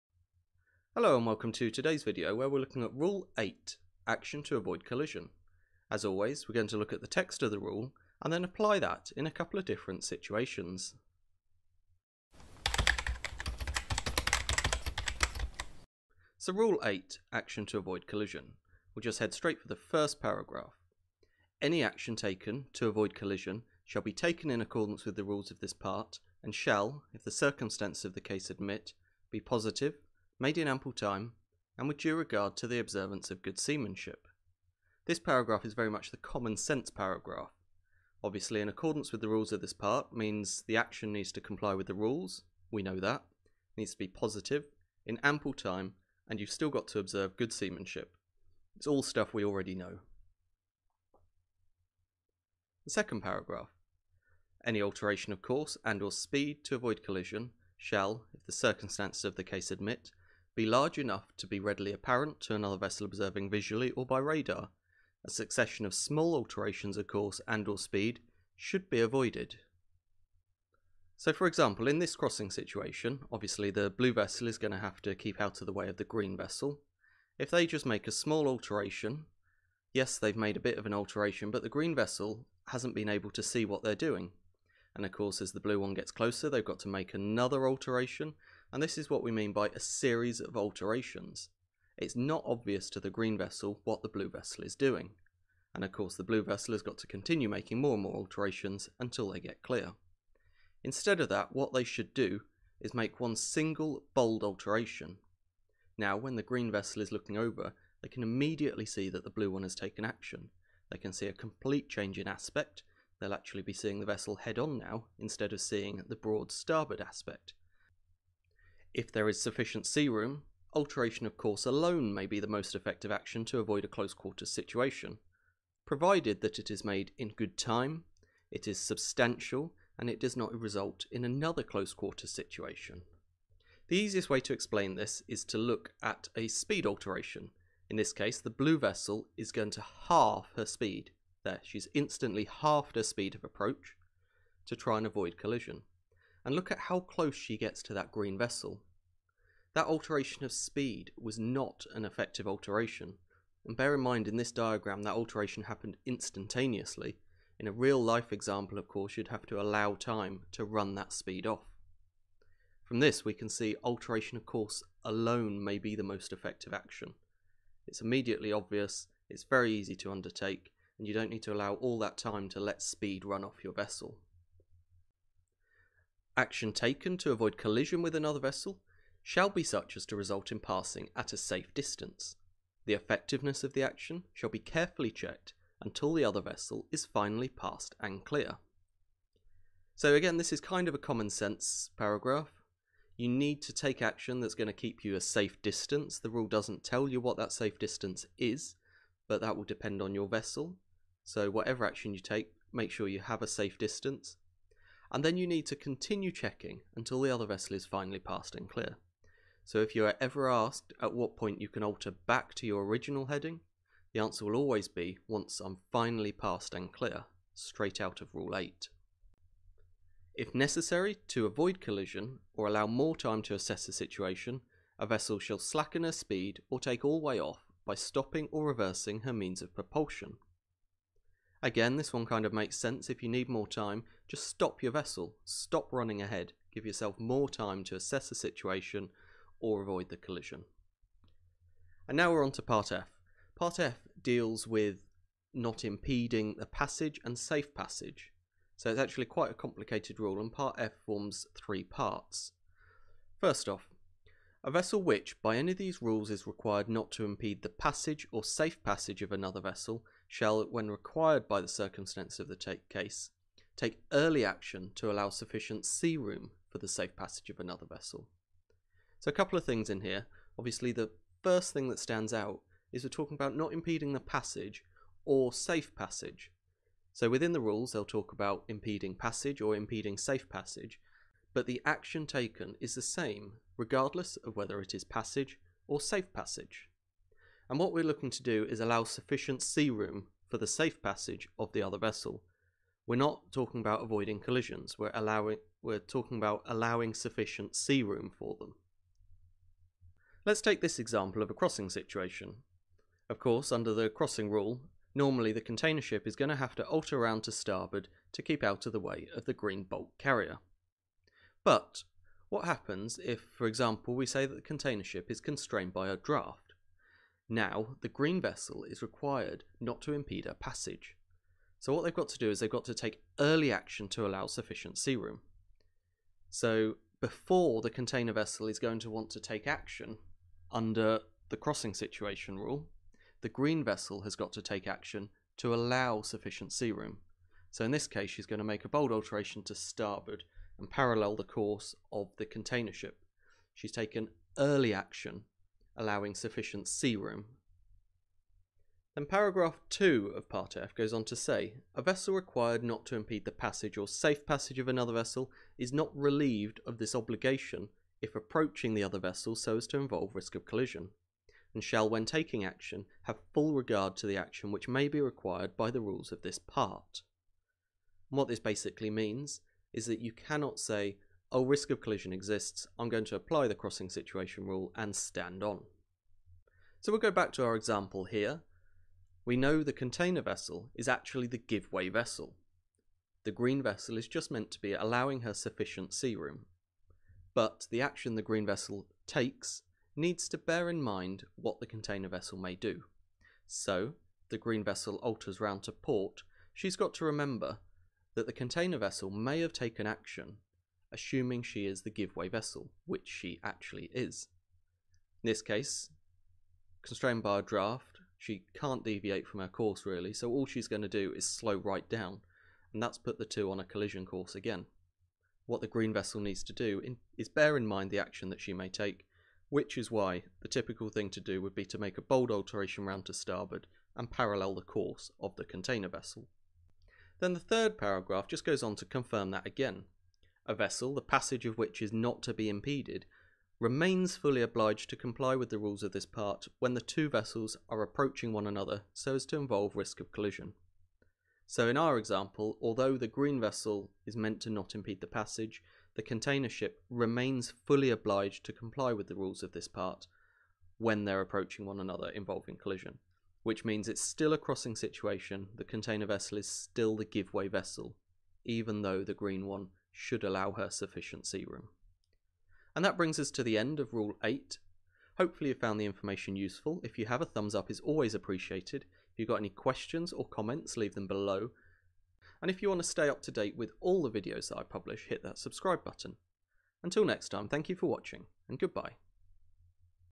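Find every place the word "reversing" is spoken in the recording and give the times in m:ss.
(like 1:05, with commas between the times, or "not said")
3:48.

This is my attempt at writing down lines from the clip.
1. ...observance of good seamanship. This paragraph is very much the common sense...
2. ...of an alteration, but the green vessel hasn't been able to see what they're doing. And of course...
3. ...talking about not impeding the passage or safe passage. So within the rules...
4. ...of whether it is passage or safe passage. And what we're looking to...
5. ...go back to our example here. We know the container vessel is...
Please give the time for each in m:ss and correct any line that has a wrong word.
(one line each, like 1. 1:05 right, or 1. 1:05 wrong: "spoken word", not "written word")
1. 0:32 right
2. 1:20 right
3. 4:33 right
4. 4:44 right
5. 6:17 right.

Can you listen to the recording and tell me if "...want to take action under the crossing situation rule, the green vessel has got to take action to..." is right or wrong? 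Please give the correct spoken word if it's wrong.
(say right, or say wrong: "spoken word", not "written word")
right.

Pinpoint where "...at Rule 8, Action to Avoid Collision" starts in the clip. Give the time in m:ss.
0:02.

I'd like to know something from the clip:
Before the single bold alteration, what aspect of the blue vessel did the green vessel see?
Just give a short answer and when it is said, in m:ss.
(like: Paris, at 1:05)
broad starboard aspect, at 1:56.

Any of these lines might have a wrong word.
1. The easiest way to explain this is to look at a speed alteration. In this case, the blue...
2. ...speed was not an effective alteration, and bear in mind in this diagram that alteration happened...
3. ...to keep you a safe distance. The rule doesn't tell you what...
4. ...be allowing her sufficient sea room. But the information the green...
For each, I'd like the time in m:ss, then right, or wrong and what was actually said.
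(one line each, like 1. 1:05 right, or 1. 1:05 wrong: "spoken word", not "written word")
1. 2:13 right
2. 2:30 right
3. 3:14 right
4. 6:24 wrong: "action", not "information".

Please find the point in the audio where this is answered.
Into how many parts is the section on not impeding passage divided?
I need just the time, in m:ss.
4:11.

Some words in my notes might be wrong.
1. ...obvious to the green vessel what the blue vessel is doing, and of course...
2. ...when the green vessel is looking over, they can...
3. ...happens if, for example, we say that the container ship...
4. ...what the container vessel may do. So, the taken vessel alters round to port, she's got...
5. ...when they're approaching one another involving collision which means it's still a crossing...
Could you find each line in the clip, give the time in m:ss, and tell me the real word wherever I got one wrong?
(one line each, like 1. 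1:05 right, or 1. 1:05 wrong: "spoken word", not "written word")
1. 1:32 right
2. 1:46 right
3. 5:12 right
4. 6:31 wrong: "green", not "taken"
5. 7:30 right.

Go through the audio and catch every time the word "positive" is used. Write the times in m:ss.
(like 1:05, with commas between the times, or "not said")
0:29, 0:44.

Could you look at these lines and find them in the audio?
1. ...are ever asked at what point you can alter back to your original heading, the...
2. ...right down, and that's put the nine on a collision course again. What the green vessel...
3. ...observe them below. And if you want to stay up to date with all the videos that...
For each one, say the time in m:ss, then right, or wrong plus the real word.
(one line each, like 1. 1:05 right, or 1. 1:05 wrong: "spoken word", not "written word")
1. 3:30 right
2. 6:51 wrong: "two", not "nine"
3. 7:50 wrong: "leave", not "observe".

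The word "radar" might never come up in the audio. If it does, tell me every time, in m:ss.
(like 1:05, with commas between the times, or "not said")
1:04.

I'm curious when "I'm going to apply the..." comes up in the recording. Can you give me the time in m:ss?
6:12.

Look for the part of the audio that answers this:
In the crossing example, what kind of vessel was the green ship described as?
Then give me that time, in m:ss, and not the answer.
5:09.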